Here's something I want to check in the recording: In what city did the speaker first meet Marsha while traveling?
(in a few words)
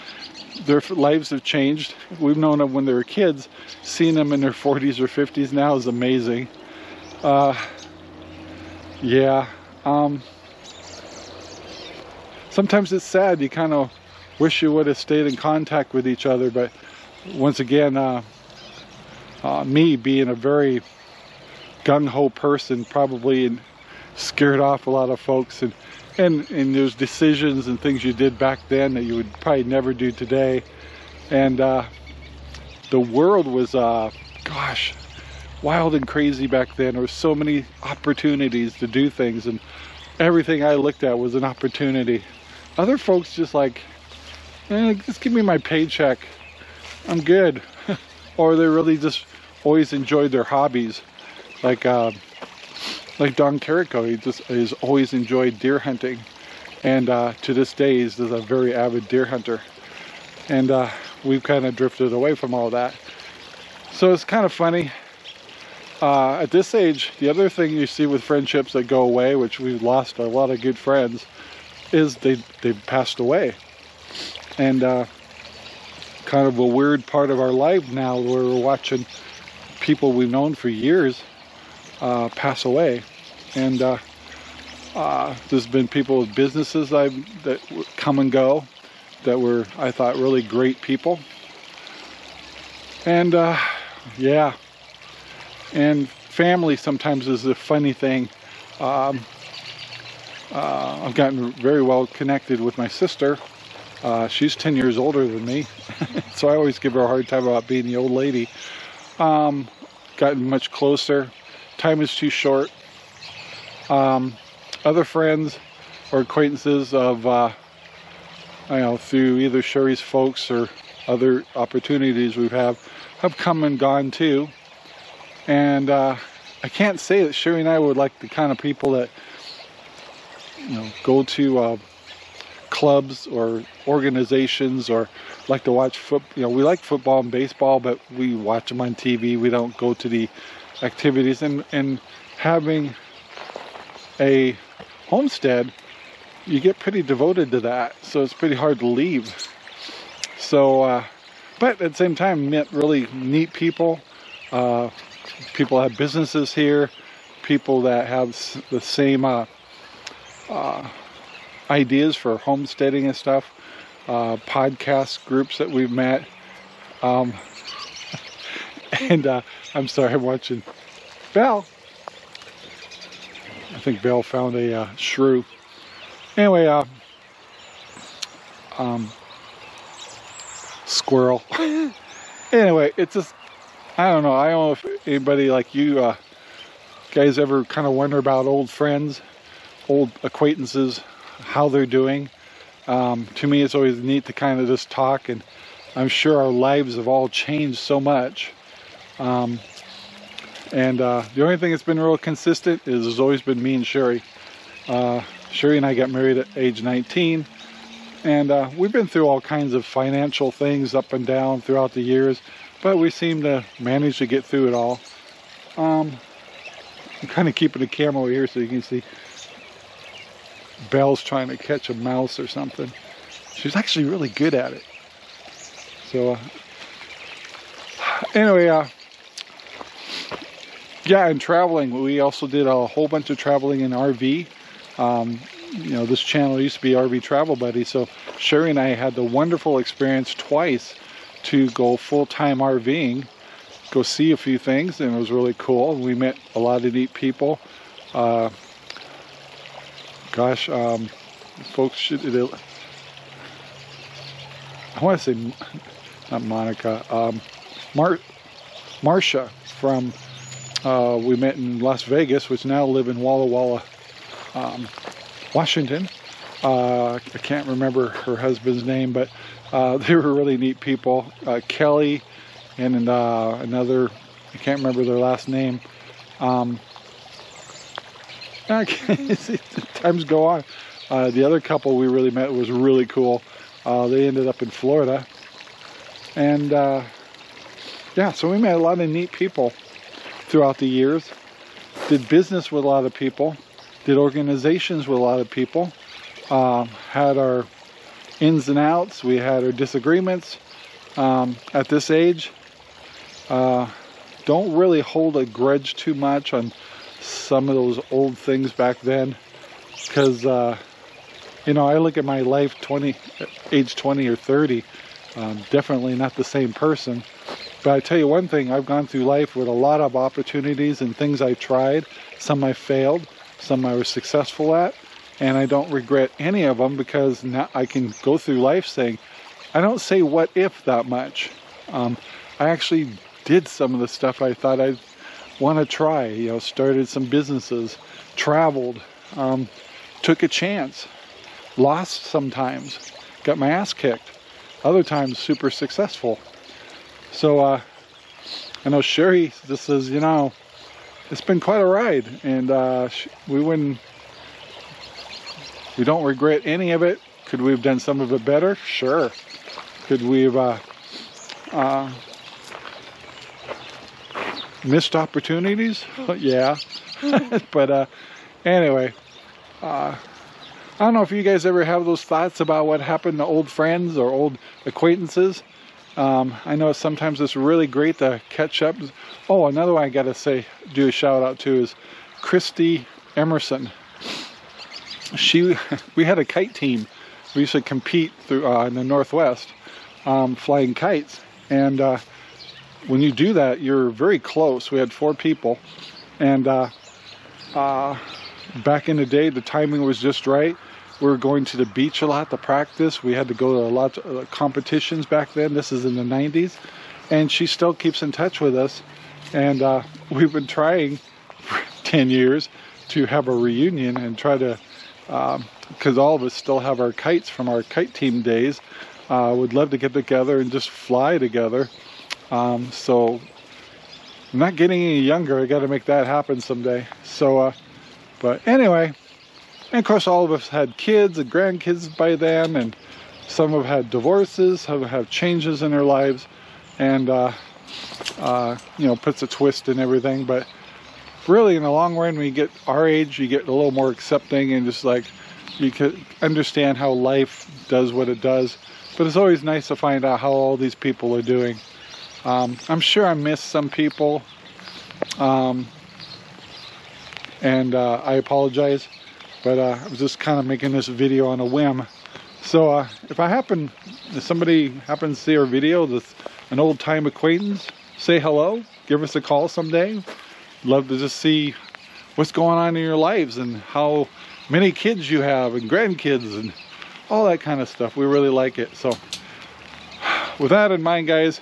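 Las Vegas.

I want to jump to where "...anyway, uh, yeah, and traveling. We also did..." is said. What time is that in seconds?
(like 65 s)
228 s.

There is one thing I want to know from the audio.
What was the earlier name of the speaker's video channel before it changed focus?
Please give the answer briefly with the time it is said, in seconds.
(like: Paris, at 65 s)
RV Travel Buddy, at 236 s.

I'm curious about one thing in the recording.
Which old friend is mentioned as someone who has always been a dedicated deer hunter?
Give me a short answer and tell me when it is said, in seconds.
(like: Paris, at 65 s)
Don Carico, at 53 s.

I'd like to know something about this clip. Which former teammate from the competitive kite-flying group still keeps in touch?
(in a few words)
Christy Emerson.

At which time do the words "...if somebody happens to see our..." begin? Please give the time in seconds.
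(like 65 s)
464 s.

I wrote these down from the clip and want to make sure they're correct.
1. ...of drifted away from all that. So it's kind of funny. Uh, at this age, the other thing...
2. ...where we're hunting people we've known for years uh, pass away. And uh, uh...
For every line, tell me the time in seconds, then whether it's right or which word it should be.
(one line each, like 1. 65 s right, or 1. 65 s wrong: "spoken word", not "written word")
1. 61 s right
2. 78 s wrong: "watching", not "hunting".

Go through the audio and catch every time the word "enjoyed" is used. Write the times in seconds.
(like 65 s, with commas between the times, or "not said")
49 s, 55 s.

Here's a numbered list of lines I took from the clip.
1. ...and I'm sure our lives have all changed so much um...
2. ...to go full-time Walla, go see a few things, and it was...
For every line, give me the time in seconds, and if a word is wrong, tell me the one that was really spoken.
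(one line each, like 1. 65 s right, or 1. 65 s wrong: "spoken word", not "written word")
1. 195 s right
2. 241 s wrong: "RVing", not "Walla".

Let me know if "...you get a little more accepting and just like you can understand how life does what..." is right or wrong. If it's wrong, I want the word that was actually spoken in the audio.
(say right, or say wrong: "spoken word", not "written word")
right.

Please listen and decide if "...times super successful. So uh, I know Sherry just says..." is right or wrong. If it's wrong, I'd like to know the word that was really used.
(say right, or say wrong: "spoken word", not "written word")
right.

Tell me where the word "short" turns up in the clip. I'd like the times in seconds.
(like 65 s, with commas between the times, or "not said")
112 s.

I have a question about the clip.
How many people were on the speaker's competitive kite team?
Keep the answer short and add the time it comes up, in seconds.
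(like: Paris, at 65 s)
4, at 395 s.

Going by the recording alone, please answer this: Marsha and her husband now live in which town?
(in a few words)
Walla Walla.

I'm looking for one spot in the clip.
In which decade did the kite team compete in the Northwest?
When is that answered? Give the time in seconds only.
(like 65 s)
406 s.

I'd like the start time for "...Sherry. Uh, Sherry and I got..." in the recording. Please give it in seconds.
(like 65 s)
203 s.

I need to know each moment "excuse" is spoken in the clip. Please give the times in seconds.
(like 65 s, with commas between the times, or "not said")
not said.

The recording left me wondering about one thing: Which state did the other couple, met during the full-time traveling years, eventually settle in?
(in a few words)
Florida.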